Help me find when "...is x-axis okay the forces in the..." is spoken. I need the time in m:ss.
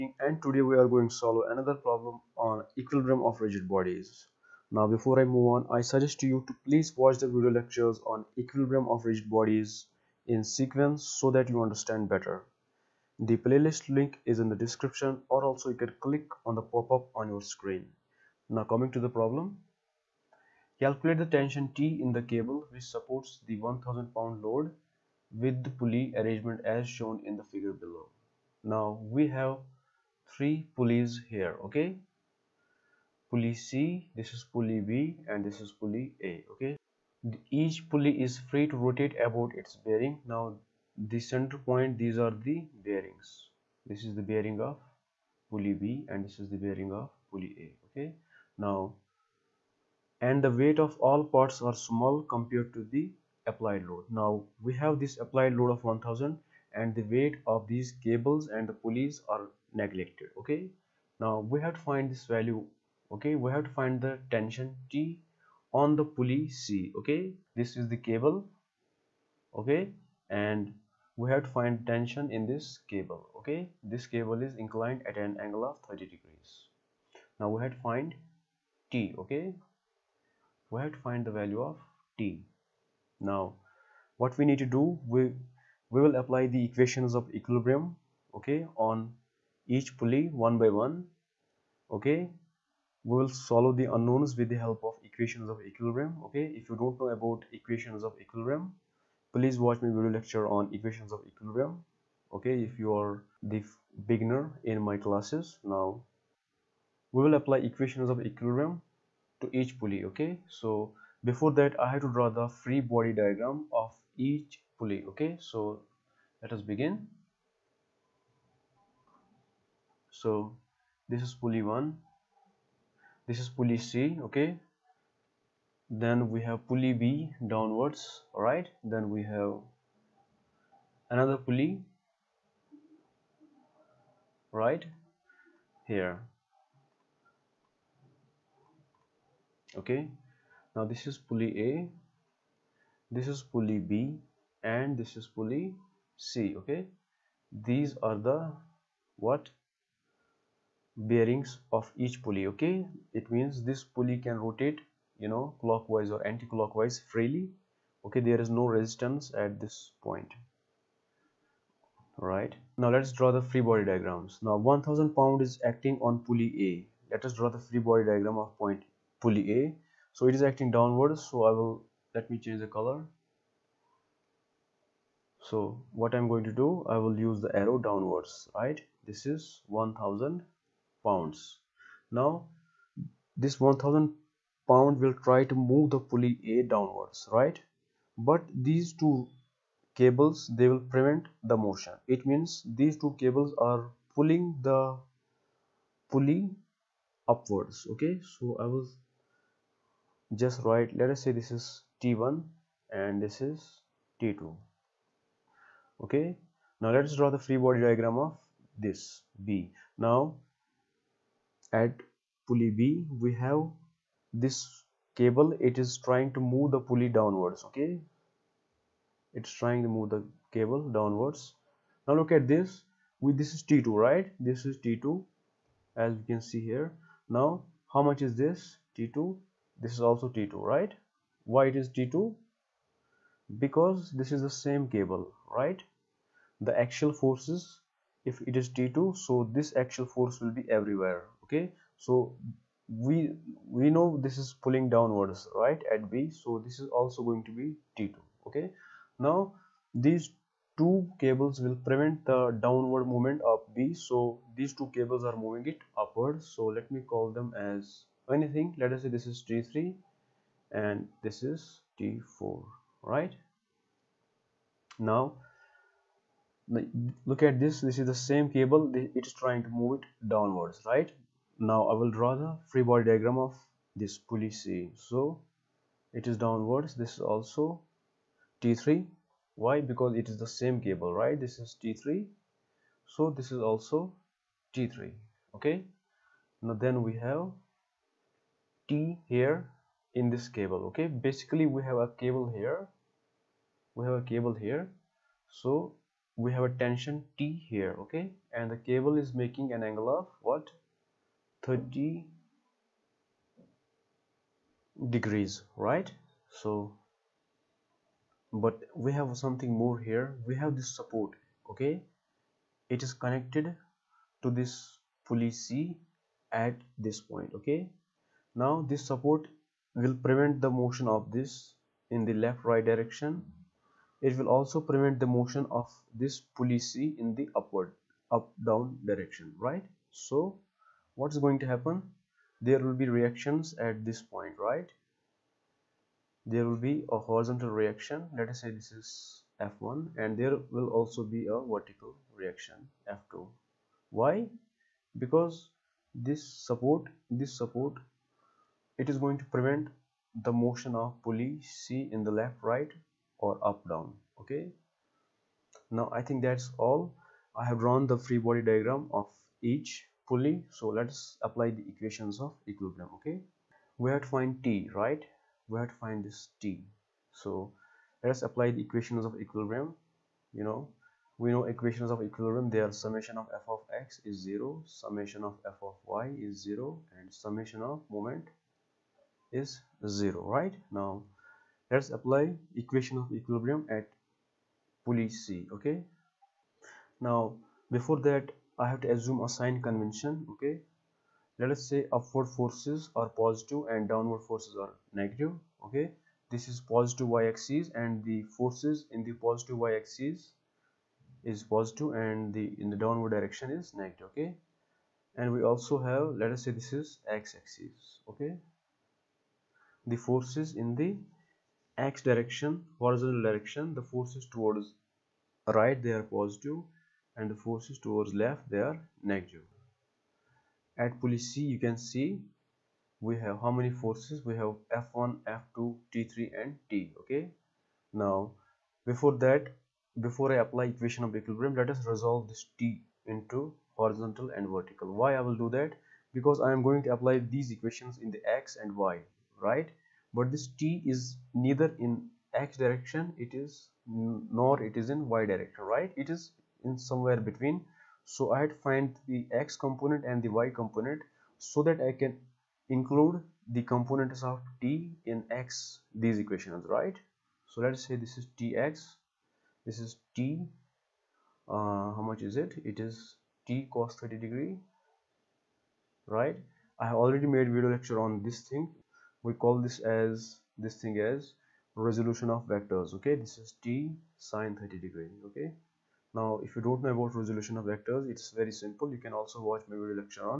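6:47.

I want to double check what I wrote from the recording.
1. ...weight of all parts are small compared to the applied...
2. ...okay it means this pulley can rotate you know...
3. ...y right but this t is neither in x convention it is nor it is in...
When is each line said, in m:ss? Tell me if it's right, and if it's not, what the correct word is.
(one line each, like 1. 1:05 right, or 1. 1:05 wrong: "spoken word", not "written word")
1. 0:50 right
2. 2:32 right
3. 7:19 wrong: "direction", not "convention".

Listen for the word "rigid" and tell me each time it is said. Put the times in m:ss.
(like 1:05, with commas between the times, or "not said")
0:03, 0:09.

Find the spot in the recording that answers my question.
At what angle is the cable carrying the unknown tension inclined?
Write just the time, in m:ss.
1:15.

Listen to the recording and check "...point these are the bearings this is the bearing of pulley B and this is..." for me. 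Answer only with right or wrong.
right.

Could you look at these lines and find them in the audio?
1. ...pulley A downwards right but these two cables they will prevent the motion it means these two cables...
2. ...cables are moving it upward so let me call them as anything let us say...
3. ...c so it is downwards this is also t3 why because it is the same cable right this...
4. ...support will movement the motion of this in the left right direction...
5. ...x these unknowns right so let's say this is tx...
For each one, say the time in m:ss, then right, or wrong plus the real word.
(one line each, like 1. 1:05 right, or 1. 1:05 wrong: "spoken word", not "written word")
1. 3:06 right
2. 4:14 right
3. 4:34 right
4. 5:19 wrong: "prevent", not "movement"
5. 7:35 wrong: "equations", not "unknowns".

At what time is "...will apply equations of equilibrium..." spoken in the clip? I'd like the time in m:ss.
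1:47.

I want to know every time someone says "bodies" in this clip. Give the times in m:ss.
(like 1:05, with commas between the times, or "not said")
0:03, 0:09.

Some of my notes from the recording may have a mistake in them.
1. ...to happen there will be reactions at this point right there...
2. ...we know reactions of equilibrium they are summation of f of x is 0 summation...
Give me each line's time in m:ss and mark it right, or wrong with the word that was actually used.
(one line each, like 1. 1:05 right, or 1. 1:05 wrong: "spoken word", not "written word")
1. 5:31 right
2. 6:11 wrong: "equations", not "reactions".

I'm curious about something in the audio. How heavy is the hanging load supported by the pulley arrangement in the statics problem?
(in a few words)
1000 pounds.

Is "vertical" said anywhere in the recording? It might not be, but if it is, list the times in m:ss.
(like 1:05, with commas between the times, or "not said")
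5:41, 7:14.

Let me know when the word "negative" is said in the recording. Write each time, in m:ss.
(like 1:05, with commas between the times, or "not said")
6:35, 6:43, 6:59.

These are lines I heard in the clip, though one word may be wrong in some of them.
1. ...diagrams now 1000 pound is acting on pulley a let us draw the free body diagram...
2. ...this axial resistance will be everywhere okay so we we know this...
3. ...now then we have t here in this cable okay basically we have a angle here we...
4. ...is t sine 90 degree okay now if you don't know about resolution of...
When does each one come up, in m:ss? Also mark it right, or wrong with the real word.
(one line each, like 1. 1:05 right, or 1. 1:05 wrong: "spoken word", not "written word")
1. 2:43 right
2. 3:59 wrong: "force", not "resistance"
3. 4:46 wrong: "cable", not "angle"
4. 7:53 wrong: "30", not "90".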